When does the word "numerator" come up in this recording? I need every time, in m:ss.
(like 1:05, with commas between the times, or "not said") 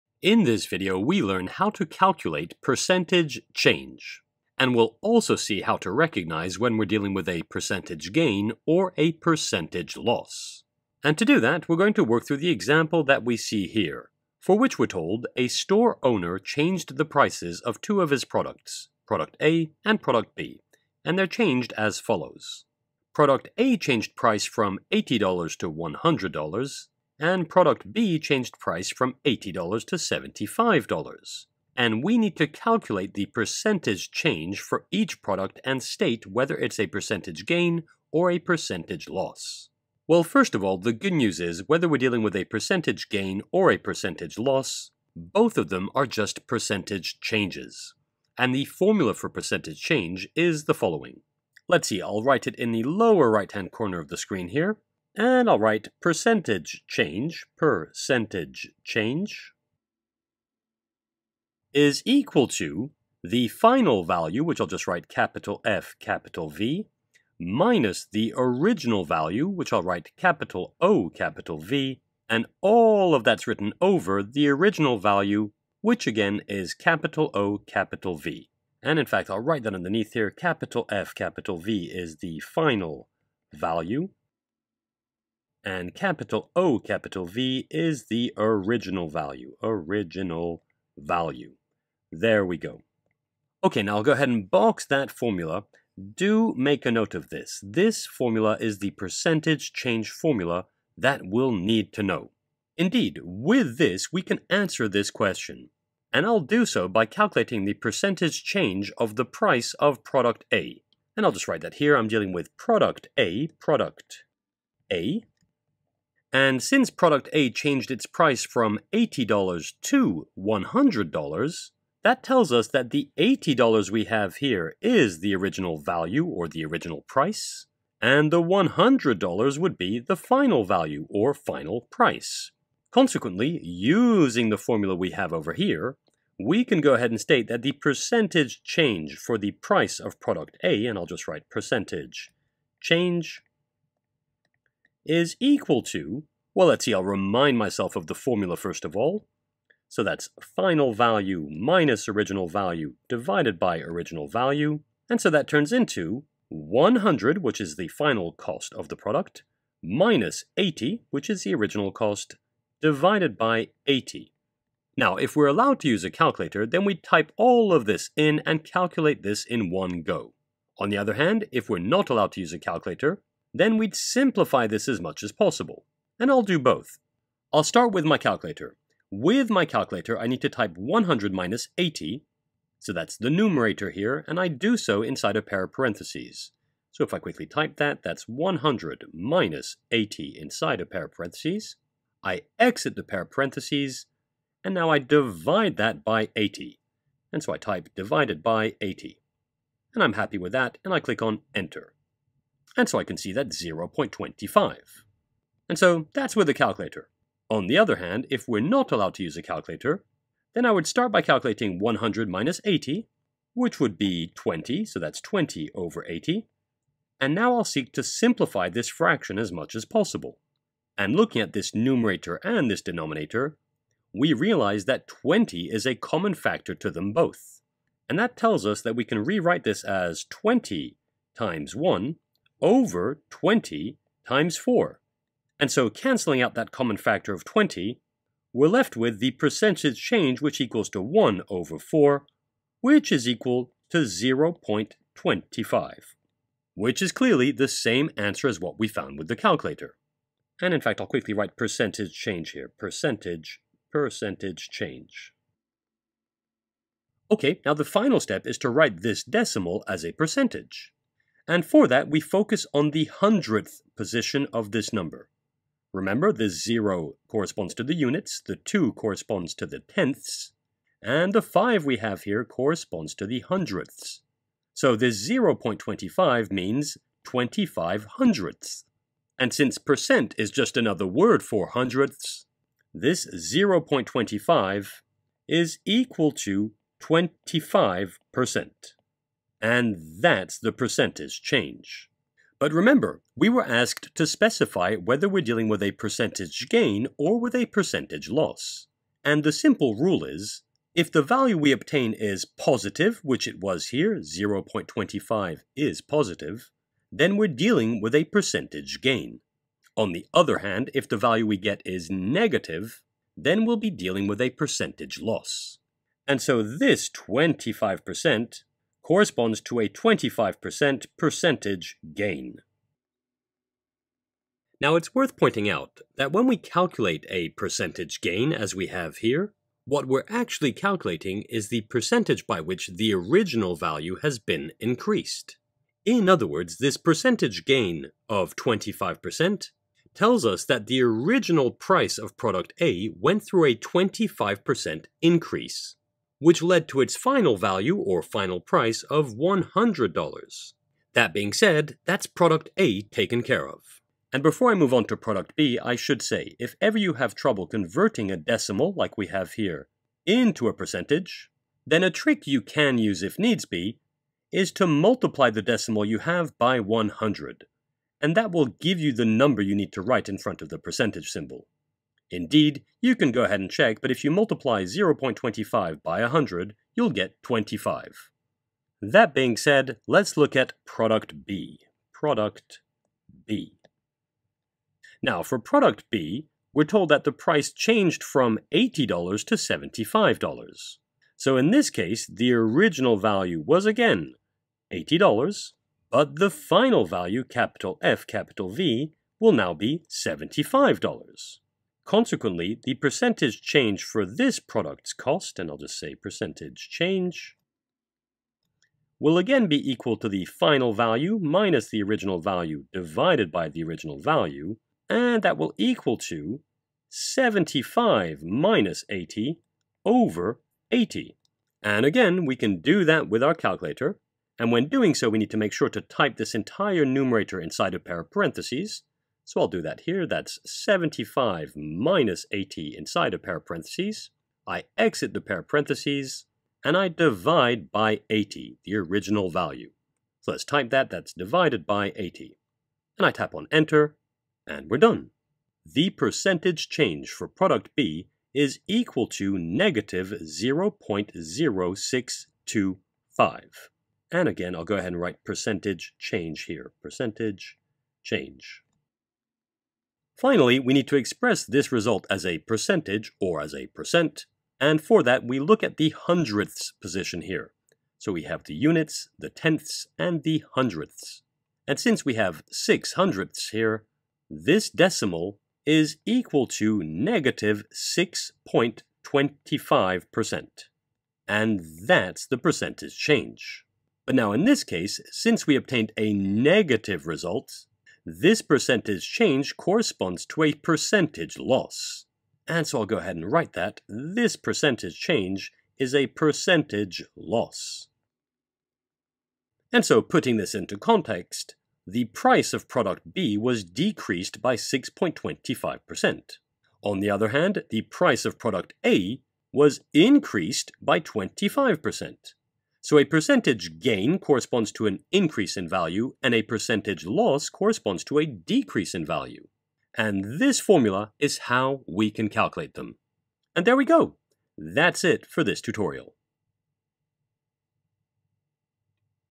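3:03, 3:41, 7:07.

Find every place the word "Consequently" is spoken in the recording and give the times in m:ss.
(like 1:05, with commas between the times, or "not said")
2:12, 6:42.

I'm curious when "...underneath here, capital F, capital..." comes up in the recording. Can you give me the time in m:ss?
1:19.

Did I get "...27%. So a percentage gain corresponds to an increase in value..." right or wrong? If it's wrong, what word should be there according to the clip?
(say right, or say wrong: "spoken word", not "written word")
wrong: "25", not "27".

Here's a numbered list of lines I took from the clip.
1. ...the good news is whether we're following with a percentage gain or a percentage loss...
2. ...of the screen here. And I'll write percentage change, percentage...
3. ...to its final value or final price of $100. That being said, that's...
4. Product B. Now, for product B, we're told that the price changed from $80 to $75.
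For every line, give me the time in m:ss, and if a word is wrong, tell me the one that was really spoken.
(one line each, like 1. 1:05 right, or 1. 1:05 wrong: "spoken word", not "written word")
1. 0:40 wrong: "dealing", not "following"
2. 0:53 right
3. 5:46 right
4. 6:22 right.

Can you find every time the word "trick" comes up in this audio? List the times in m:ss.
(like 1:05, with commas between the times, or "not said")
6:02.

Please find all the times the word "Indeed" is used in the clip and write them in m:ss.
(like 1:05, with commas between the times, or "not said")
1:42, 6:12.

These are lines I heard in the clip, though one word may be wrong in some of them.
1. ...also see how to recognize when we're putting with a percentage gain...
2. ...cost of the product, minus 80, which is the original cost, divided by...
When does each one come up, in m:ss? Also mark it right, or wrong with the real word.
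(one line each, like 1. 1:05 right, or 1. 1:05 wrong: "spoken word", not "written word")
1. 0:05 wrong: "dealing", not "putting"
2. 2:38 right.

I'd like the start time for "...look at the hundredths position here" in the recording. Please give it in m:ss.
7:45.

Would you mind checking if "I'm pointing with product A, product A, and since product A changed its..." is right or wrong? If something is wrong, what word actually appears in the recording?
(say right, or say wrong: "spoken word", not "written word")
wrong: "dealing", not "pointing".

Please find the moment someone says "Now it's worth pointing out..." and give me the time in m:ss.
5:24.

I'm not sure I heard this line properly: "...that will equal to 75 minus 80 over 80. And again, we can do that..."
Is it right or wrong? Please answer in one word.
right.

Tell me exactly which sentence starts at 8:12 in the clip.
And so I'll go ahead and write that this percentage change is a percentage loss.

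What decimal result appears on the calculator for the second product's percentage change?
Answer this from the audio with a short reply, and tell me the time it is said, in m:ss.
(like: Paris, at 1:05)
-0.0625, at 7:29.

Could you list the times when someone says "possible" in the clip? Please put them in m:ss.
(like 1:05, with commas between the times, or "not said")
2:55, 3:39.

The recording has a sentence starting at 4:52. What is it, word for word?
But remember, we were asked to specify whether we're dealing with a percentage gain or with a percentage loss.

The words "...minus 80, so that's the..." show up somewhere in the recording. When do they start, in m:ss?
3:01.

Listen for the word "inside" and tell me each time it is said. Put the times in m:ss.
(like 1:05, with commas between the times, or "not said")
3:05, 3:10, 7:07, 7:12.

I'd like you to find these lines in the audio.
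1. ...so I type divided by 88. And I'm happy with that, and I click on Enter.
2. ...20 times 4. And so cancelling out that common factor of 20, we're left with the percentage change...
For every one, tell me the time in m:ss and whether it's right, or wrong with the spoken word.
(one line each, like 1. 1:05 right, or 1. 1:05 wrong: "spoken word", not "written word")
1. 3:17 wrong: "80", not "88"
2. 3:53 right.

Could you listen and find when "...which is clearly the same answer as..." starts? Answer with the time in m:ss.
4:06.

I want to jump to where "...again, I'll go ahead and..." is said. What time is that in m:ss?
7:34.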